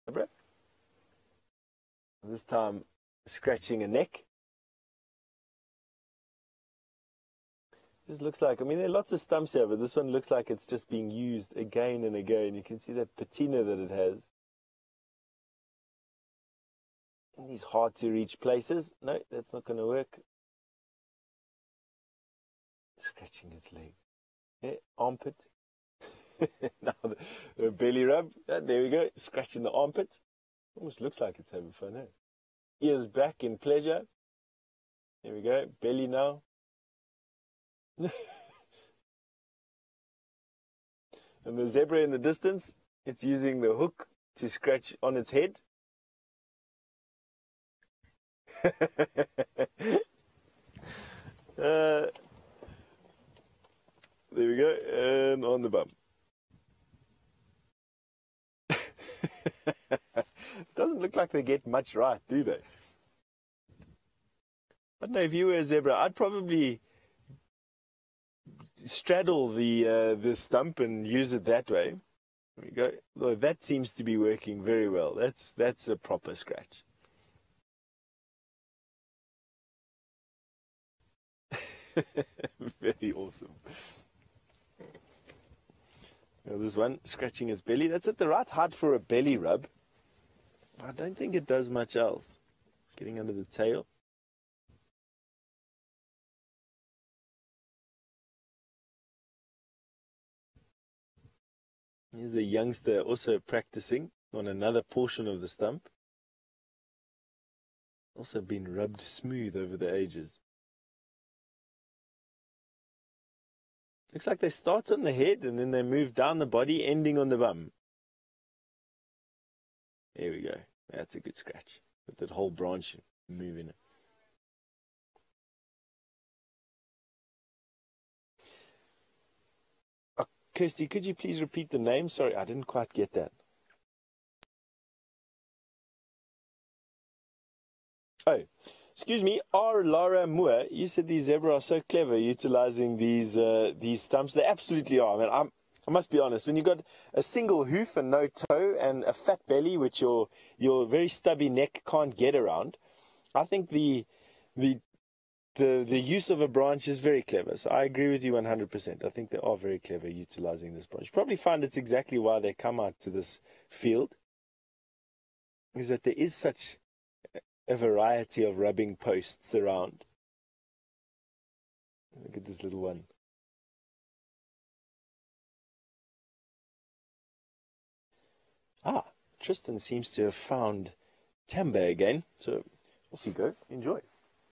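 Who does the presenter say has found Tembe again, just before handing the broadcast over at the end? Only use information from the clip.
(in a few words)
Tristan.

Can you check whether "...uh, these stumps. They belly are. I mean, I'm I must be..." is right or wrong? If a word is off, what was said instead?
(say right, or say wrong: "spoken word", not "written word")
wrong: "absolutely", not "belly".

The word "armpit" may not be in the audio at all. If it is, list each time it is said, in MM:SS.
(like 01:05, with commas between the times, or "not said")
00:24, 00:29.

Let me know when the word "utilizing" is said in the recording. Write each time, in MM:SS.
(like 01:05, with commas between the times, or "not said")
02:22, 02:40.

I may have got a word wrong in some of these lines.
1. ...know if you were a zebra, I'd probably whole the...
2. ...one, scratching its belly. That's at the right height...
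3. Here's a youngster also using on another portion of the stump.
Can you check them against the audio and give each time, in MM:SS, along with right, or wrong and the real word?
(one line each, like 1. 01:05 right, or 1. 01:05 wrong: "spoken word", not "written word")
1. 01:05 wrong: "straddle", not "whole"
2. 01:26 right
3. 01:42 wrong: "practicing", not "using".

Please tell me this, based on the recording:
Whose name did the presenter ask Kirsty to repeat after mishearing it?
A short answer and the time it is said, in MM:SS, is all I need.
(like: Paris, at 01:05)
R. Laura Moore, at 02:19.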